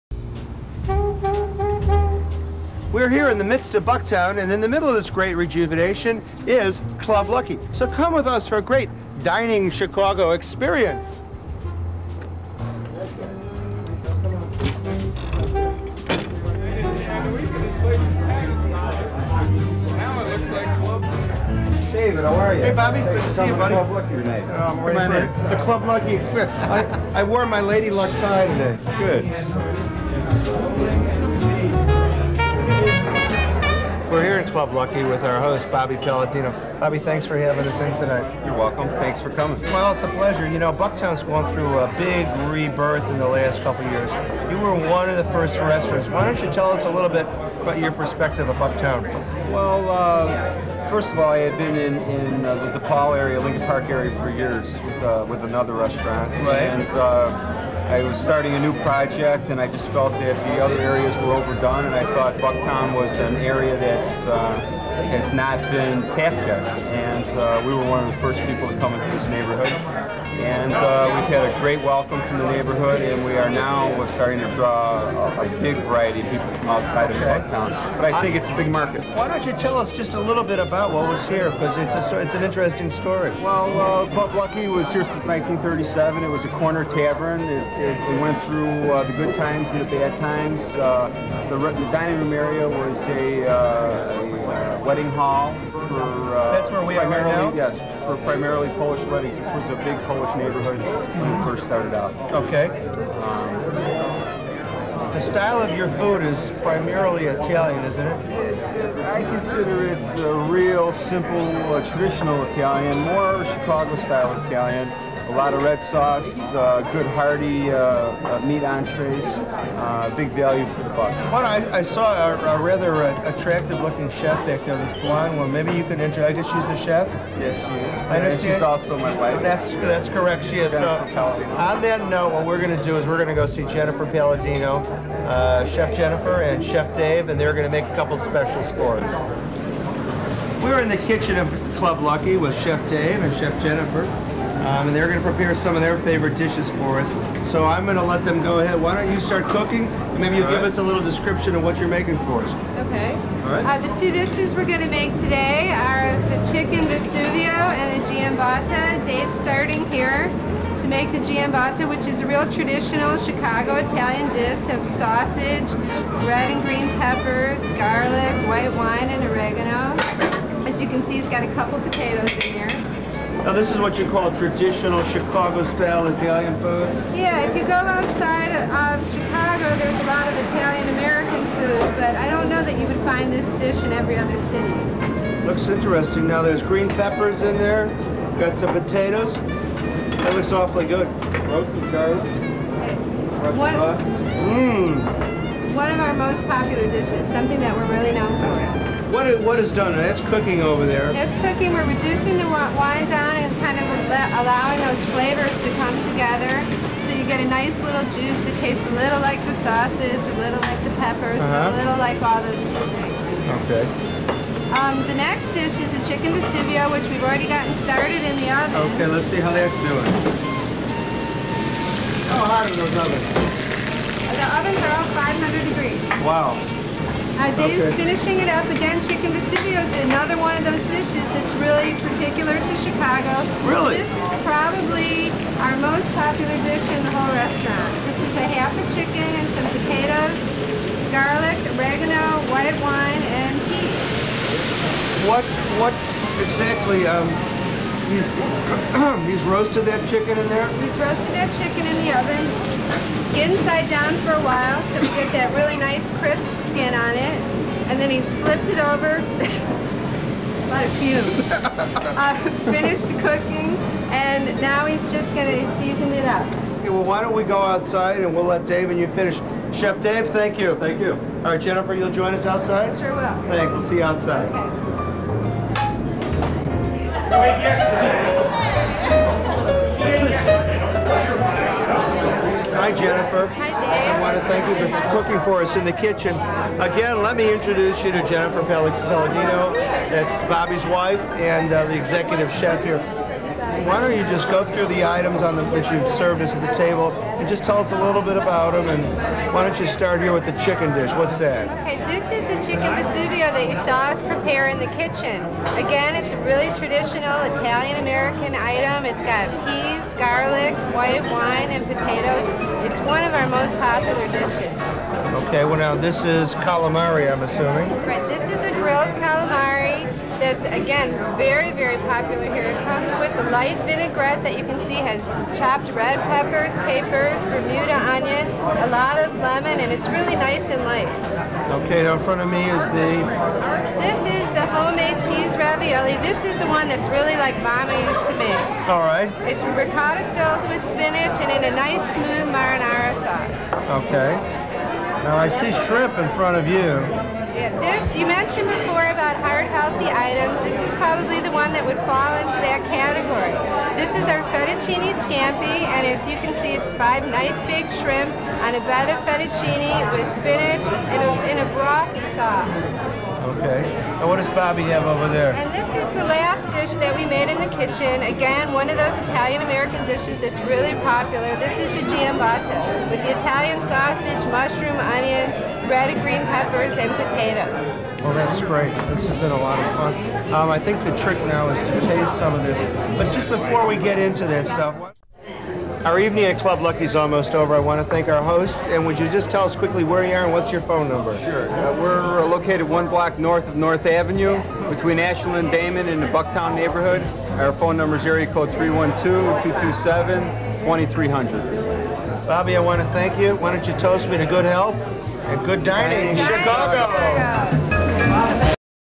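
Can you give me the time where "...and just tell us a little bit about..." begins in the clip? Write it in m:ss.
4:57.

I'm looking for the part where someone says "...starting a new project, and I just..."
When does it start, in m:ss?
0:58.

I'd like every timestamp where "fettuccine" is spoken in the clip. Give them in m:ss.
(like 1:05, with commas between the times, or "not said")
5:54, 5:59.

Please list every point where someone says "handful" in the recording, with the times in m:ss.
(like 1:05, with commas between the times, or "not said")
not said.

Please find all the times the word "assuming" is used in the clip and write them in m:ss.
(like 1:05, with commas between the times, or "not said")
5:17.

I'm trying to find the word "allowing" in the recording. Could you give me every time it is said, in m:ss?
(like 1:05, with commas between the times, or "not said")
3:24.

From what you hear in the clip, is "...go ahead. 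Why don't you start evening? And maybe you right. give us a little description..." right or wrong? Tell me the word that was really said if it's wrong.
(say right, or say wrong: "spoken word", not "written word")
wrong: "cooking", not "evening".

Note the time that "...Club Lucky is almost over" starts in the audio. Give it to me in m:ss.
6:26.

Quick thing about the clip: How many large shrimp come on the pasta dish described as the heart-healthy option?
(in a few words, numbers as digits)
5.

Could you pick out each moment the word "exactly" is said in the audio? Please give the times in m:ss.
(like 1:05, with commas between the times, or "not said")
4:06.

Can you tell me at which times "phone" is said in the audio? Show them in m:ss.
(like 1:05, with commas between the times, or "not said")
6:30, 6:37.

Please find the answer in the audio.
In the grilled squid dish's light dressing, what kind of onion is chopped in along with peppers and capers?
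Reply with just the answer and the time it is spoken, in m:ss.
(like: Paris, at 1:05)
Bermuda onion, at 5:27.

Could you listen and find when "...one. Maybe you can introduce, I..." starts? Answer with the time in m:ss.
2:05.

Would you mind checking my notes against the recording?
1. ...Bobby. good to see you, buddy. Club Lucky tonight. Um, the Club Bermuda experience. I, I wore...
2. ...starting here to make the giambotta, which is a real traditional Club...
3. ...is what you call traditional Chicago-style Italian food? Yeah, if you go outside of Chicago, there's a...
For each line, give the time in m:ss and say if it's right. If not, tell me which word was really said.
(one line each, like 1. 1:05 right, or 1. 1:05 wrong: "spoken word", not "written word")
1. 0:22 wrong: "Lucky", not "Bermuda"
2. 2:39 wrong: "Chicago", not "Club"
3. 2:53 right.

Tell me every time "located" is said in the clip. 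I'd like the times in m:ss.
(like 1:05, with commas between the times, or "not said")
6:32.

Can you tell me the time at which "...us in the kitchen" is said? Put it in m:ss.
4:45.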